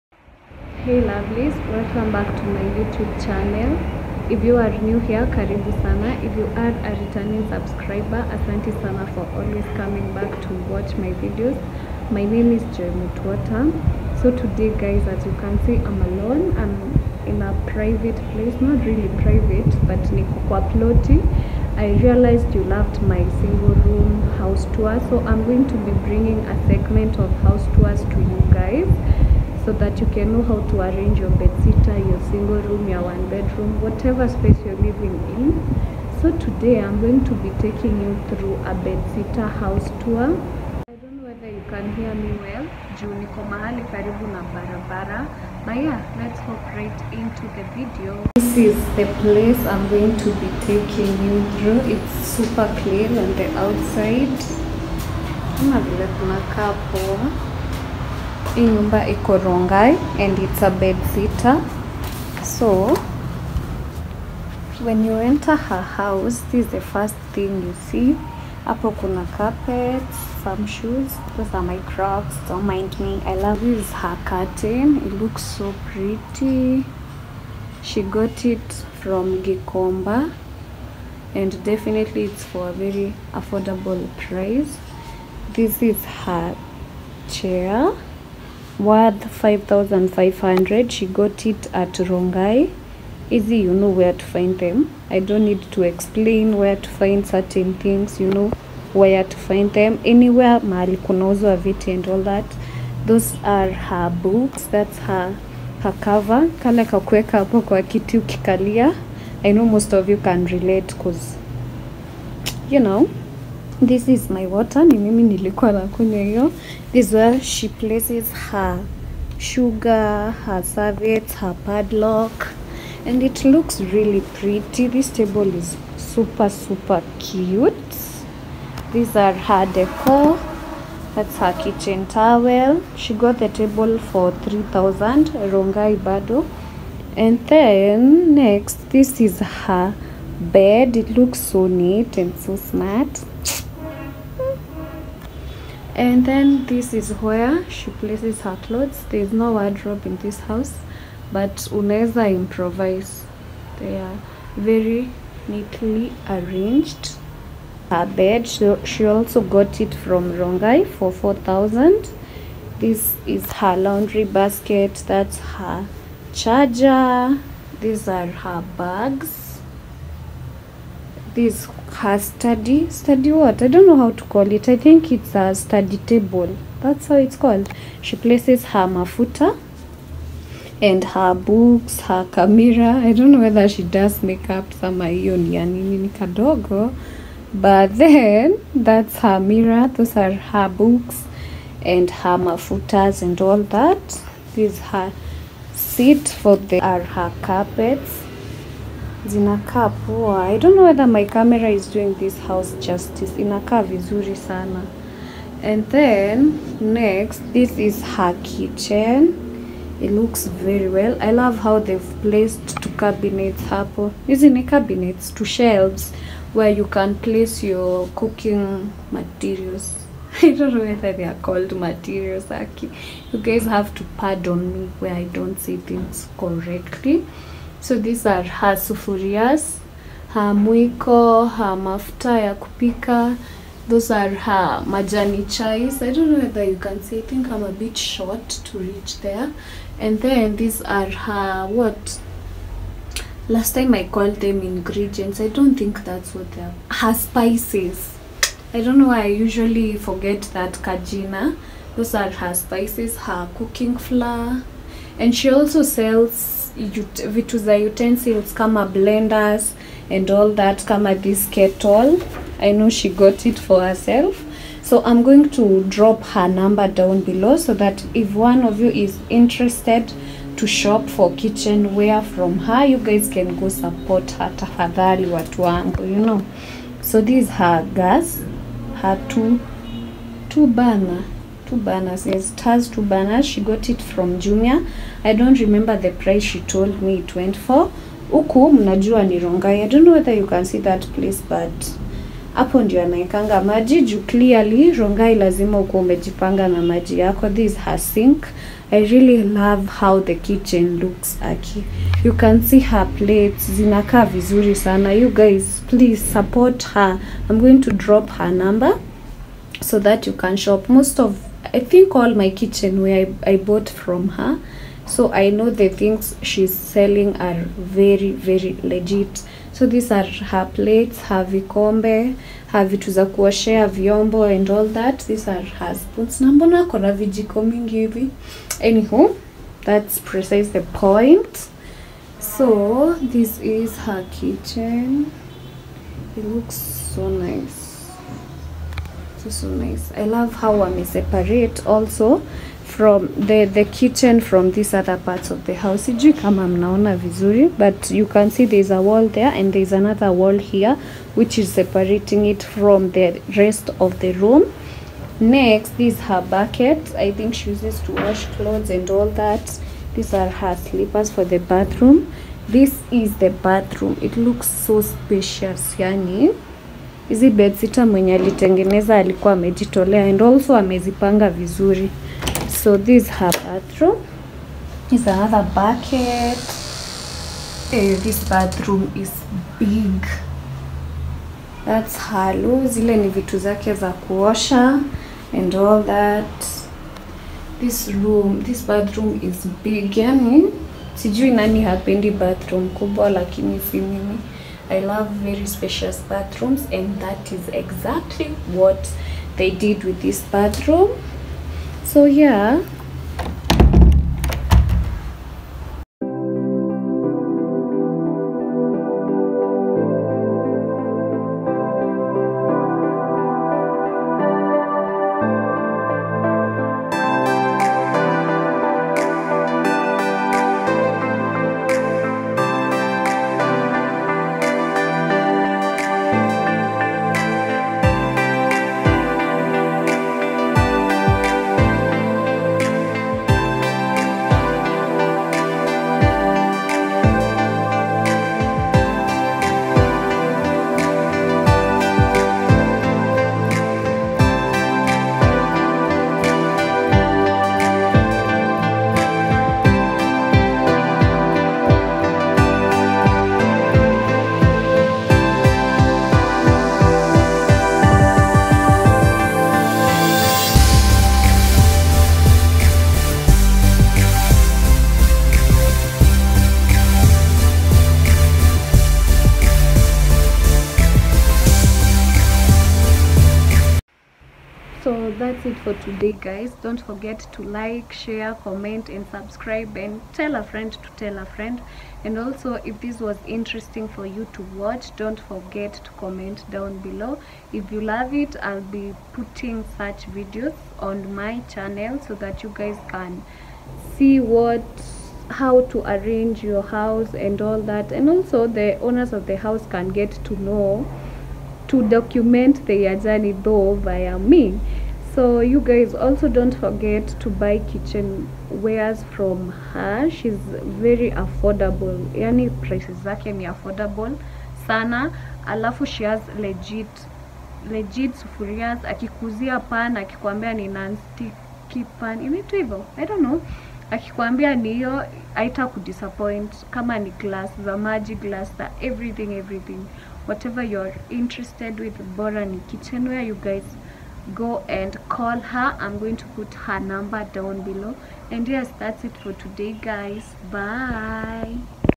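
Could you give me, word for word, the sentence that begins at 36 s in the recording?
So today I'm going to be taking you through a bed sitter house tour.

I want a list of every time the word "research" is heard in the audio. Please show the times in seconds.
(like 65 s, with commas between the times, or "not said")
not said.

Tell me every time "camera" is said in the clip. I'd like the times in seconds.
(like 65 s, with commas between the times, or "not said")
182 s, 201 s.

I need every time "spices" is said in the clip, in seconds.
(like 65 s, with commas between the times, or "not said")
247 s, 252 s.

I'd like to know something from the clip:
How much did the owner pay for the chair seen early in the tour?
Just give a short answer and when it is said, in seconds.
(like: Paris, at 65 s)
5500, at 89 s.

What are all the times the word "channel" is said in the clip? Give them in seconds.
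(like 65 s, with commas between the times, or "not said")
3 s, 491 s.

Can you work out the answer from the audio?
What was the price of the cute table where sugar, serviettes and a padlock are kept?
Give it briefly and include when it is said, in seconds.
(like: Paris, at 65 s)
3000, at 134 s.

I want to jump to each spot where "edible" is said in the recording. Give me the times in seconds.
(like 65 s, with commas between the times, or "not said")
not said.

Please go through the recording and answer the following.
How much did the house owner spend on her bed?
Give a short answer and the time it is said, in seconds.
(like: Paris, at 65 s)
4000, at 161 s.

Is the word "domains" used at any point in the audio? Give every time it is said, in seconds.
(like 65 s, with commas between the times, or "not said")
not said.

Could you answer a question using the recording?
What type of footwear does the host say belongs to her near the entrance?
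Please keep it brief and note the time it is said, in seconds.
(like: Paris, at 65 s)
Crocs, at 71 s.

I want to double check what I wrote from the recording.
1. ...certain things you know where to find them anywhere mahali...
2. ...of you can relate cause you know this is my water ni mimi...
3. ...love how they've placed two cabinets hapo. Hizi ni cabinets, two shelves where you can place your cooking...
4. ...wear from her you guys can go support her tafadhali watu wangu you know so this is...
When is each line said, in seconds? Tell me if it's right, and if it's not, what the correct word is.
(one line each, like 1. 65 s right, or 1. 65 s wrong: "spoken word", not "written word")
1. 97 s right
2. 109 s right
3. 211 s right
4. 271 s right.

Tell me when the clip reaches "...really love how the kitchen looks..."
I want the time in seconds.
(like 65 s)
299 s.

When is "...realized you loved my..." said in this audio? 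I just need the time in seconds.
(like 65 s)
22 s.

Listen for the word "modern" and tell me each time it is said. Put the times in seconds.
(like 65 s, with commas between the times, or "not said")
not said.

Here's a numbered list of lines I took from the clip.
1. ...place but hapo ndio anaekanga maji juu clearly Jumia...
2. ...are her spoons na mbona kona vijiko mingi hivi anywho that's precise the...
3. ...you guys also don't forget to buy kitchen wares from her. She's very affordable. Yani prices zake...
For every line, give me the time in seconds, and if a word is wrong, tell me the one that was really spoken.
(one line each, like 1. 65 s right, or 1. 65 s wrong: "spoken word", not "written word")
1. 291 s wrong: "Rongai", not "Jumia"
2. 325 s right
3. 505 s right.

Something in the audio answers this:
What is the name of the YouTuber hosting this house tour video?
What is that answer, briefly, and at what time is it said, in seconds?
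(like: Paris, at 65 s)
Joy Mutwata, at 12 s.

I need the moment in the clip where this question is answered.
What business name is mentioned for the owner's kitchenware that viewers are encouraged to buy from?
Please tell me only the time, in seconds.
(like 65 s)
532 s.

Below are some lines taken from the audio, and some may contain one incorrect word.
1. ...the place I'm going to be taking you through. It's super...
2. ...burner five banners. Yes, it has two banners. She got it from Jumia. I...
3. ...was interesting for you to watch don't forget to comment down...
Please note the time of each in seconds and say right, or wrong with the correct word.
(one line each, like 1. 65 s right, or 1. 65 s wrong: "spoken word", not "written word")
1. 48 s right
2. 280 s wrong: "two", not "five"
3. 483 s right.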